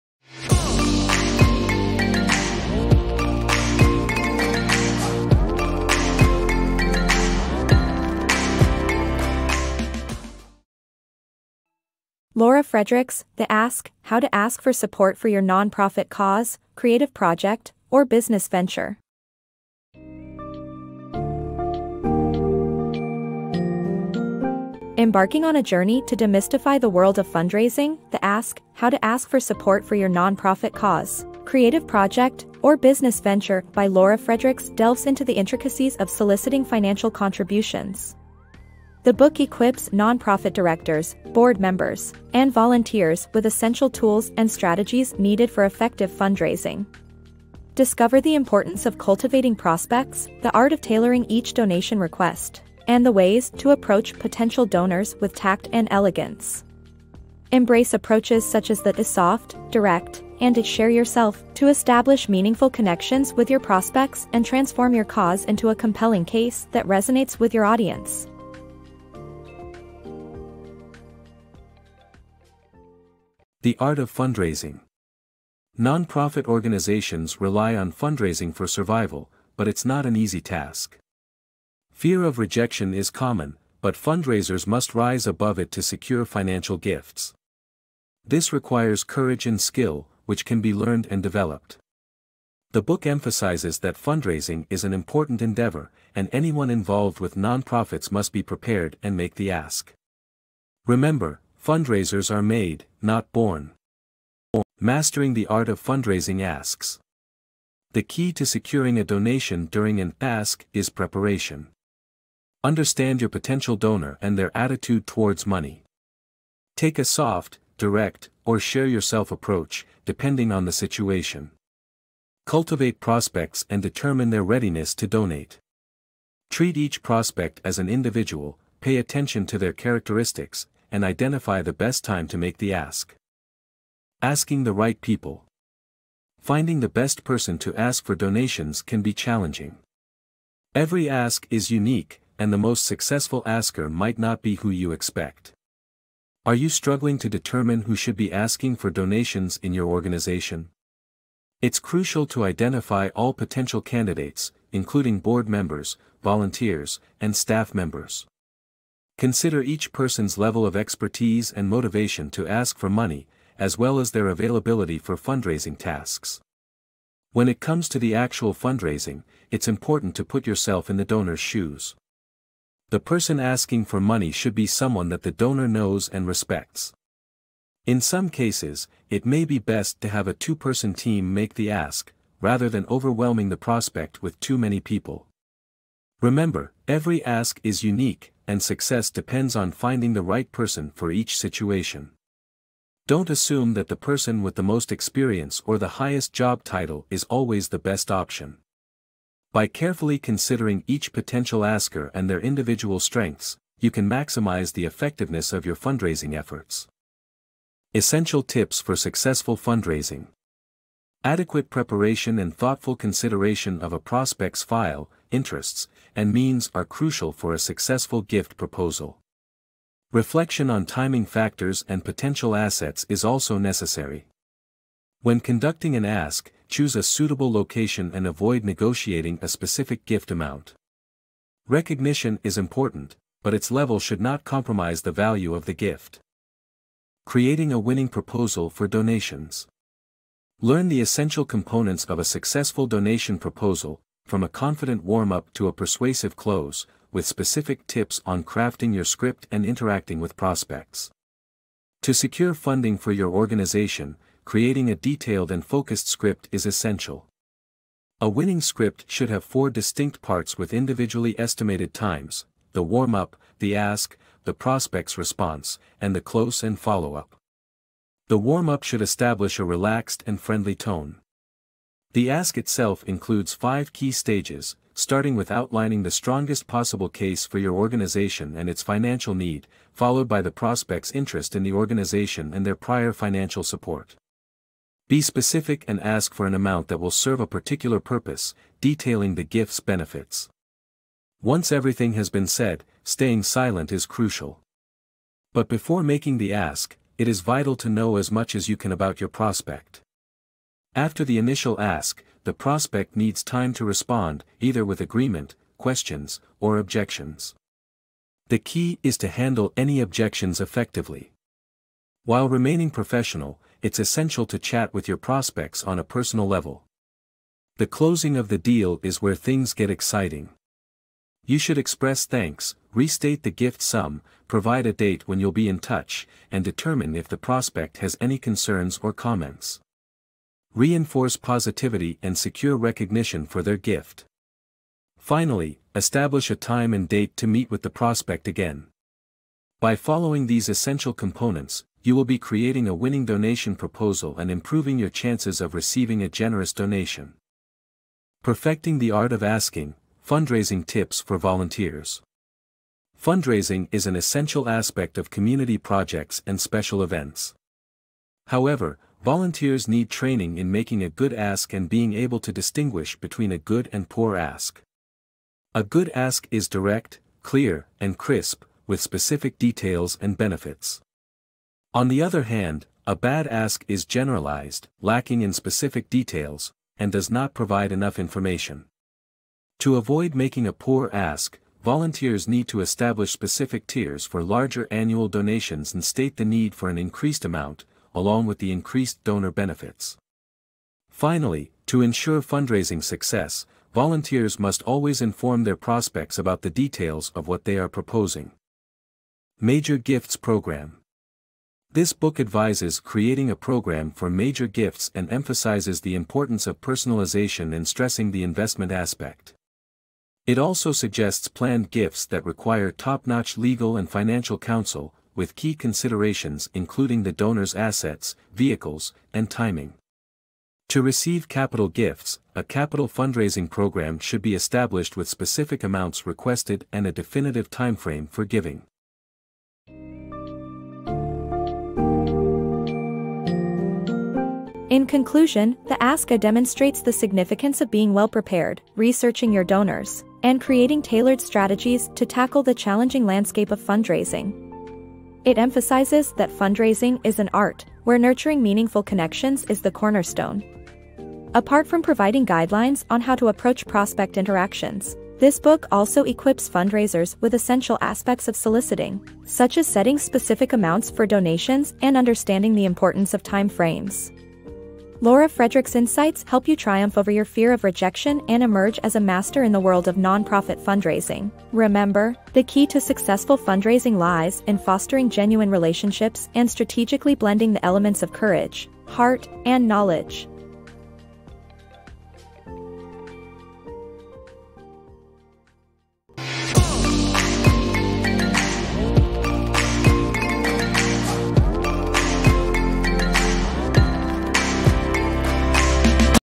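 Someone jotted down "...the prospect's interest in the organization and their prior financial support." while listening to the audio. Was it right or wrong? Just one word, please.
right.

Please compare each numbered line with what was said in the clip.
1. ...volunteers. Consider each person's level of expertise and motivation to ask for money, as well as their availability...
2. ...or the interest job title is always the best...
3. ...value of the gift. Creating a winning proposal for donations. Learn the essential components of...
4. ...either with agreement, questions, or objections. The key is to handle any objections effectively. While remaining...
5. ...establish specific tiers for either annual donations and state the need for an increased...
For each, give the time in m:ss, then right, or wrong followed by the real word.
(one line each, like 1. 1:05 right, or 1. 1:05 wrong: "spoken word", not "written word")
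1. 2:37 wrong: "members", not "volunteers"
2. 3:15 wrong: "highest", not "interest"
3. 3:55 right
4. 5:04 right
5. 6:22 wrong: "larger", not "either".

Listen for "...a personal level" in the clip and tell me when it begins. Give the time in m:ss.
5:15.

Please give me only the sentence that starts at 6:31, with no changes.
Finally, to ensure fundraising success, volunteers must always inform their prospects about the details of what they are proposing.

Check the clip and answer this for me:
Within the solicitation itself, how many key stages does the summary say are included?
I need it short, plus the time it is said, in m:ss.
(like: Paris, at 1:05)
5, at 4:33.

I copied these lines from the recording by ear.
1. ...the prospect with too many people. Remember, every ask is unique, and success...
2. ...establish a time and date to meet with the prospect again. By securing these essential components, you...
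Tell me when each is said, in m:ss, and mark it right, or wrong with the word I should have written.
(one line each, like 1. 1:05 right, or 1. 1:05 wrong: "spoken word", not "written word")
1. 3:03 right
2. 5:35 wrong: "following", not "securing".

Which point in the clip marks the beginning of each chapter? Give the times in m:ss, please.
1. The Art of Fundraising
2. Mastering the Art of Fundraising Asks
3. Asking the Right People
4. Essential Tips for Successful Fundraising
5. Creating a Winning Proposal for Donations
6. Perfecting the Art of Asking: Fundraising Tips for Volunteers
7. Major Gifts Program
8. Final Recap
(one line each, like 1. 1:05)
1. 1:14
2. 1:45
3. 2:14
4. 3:28
5. 3:57
6. 5:49
7. 6:40
8. 7:10.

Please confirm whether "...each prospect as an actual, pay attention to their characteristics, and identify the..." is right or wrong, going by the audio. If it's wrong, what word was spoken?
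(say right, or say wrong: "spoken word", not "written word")
wrong: "individual", not "actual".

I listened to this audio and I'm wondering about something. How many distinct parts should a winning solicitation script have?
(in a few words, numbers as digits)
4.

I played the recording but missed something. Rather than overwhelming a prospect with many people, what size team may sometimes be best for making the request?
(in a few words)
two-person team.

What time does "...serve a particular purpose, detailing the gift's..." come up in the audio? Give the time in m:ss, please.
4:47.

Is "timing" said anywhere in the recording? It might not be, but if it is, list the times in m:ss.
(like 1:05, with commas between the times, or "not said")
3:40, 6:59.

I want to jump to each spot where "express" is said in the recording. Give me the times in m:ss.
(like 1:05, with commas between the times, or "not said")
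5:21.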